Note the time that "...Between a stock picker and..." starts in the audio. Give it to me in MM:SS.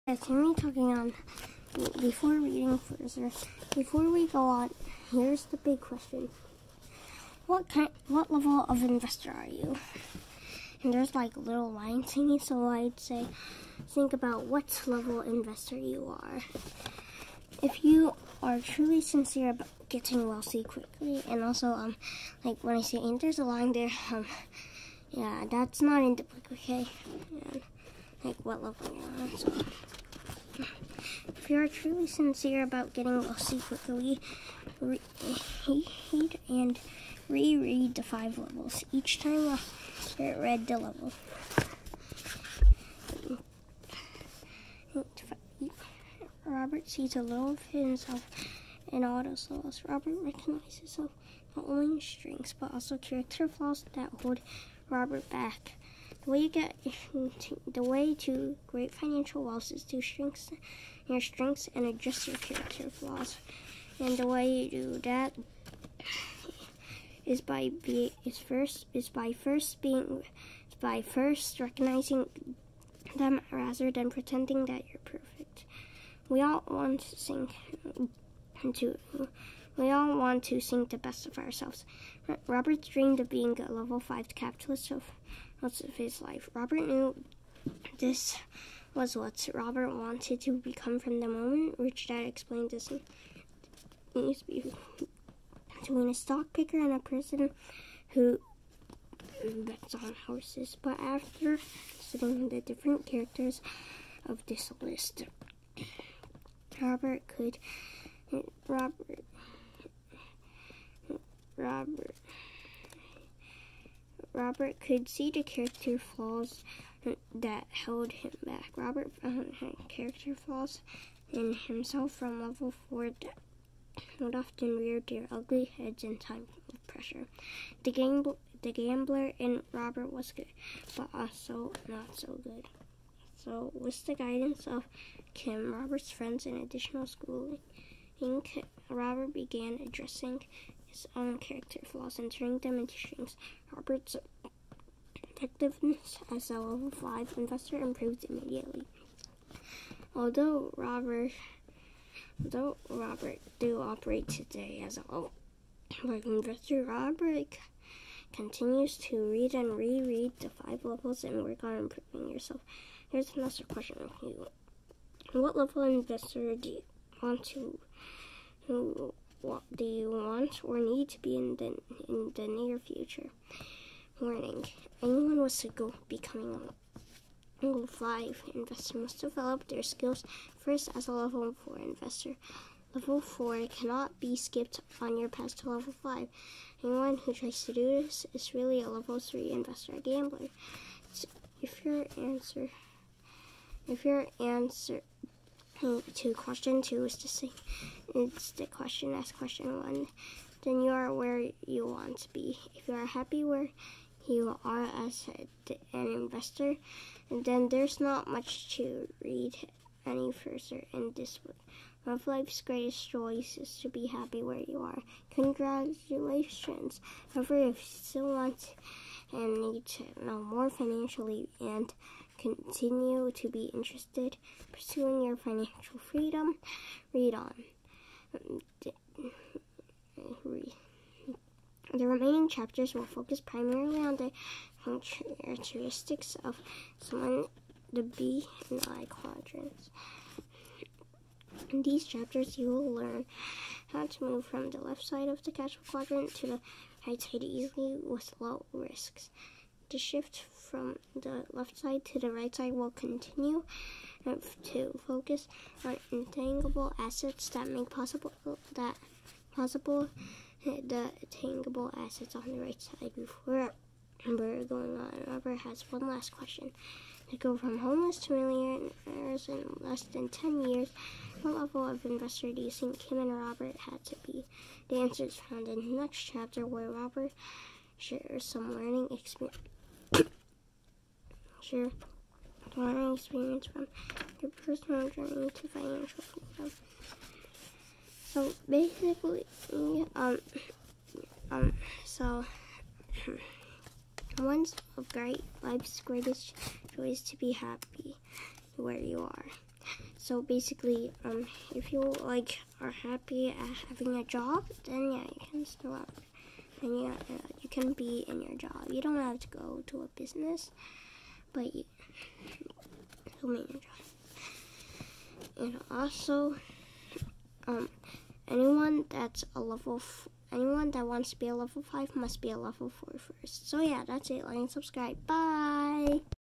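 01:34.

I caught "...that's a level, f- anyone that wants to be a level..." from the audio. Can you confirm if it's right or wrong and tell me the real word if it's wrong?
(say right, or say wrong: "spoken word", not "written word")
right.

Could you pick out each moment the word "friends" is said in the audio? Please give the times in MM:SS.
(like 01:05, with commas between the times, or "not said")
02:16.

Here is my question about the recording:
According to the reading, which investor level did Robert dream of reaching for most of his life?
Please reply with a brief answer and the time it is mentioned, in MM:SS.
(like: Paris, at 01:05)
Level 5 capitalist, at 01:23.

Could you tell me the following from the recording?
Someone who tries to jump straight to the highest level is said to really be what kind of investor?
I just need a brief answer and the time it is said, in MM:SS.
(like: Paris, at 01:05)
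Level 3 investor gambler, at 03:08.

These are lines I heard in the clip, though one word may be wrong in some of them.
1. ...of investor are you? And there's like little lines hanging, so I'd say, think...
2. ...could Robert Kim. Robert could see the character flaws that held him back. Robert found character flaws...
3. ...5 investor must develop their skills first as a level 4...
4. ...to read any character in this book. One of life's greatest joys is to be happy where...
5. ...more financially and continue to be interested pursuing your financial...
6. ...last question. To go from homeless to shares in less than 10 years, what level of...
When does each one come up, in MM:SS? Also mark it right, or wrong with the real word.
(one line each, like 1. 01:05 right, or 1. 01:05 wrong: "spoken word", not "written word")
1. 00:08 right
2. 01:47 wrong: "Robert", not "Kim"
3. 02:57 right
4. 03:28 wrong: "further", not "character"
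5. 03:40 right
6. 04:26 wrong: "millionaires", not "shares".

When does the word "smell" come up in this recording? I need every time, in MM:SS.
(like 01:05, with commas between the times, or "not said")
not said.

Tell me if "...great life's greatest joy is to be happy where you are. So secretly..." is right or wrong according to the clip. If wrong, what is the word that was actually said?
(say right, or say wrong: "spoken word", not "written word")
wrong: "basically", not "secretly".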